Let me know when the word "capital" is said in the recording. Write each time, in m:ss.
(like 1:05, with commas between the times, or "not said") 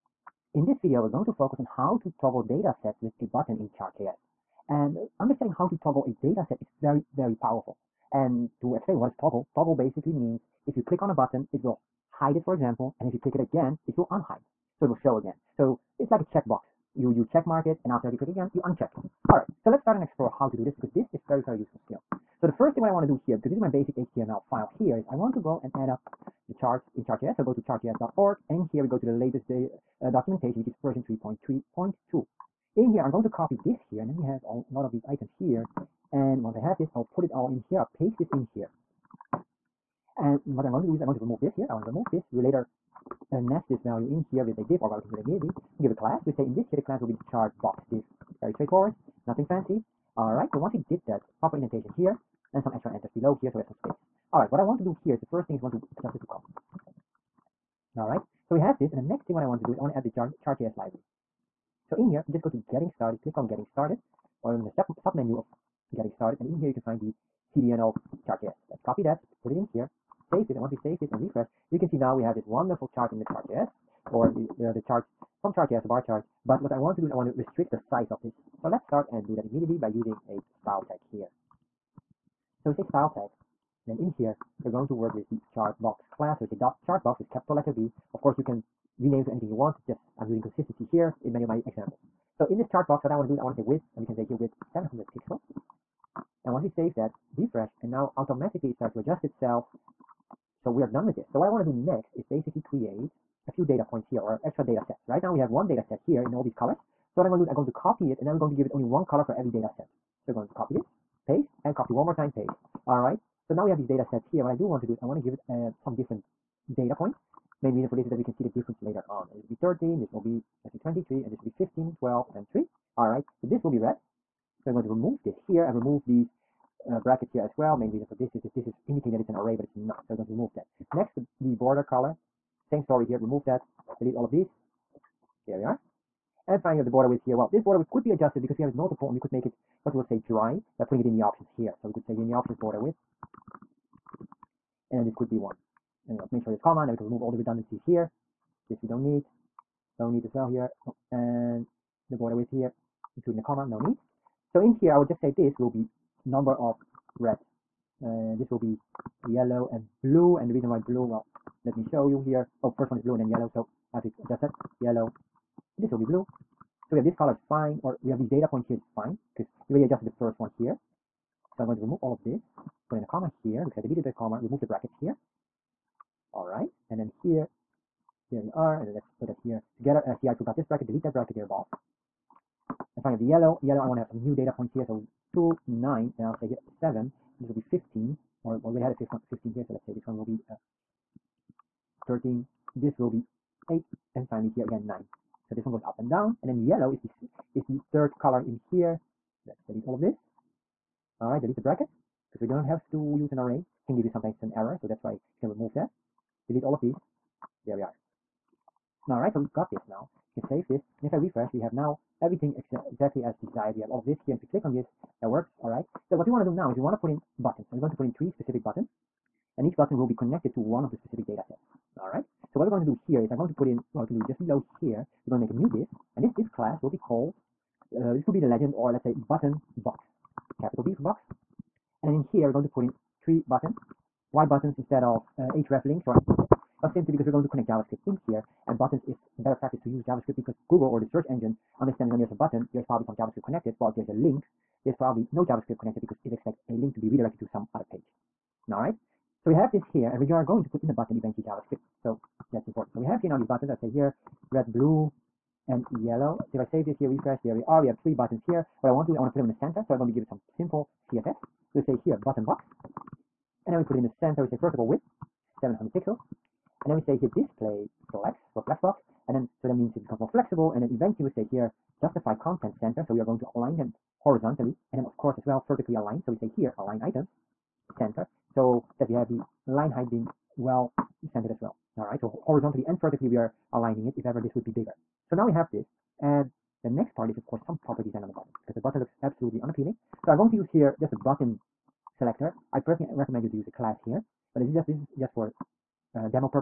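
1:27, 3:50.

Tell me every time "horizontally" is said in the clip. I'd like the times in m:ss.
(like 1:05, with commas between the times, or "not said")
4:34, 4:42.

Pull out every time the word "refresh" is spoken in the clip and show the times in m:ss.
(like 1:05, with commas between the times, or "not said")
1:11, 1:37, 3:31, 4:17.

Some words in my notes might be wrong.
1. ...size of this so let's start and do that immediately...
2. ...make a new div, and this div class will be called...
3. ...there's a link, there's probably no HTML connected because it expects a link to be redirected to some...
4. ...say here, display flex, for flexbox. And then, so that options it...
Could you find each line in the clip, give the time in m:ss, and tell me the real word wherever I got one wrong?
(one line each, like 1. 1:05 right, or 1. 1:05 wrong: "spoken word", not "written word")
1. 1:17 right
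2. 3:45 right
3. 4:03 wrong: "JavaScript", not "HTML"
4. 4:26 wrong: "means", not "options".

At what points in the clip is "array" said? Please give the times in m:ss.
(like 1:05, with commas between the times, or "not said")
2:09, 3:23.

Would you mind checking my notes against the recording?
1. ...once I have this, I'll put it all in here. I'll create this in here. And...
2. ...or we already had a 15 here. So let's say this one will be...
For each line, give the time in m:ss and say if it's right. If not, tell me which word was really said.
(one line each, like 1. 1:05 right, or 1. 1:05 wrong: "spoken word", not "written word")
1. 0:36 wrong: "paste", not "create"
2. 3:08 right.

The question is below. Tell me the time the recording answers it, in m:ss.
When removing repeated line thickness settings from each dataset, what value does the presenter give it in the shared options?
2:25.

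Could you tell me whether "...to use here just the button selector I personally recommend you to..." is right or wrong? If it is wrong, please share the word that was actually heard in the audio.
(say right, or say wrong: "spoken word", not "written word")
right.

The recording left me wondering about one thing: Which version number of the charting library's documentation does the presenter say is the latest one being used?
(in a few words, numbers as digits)
3.3.2.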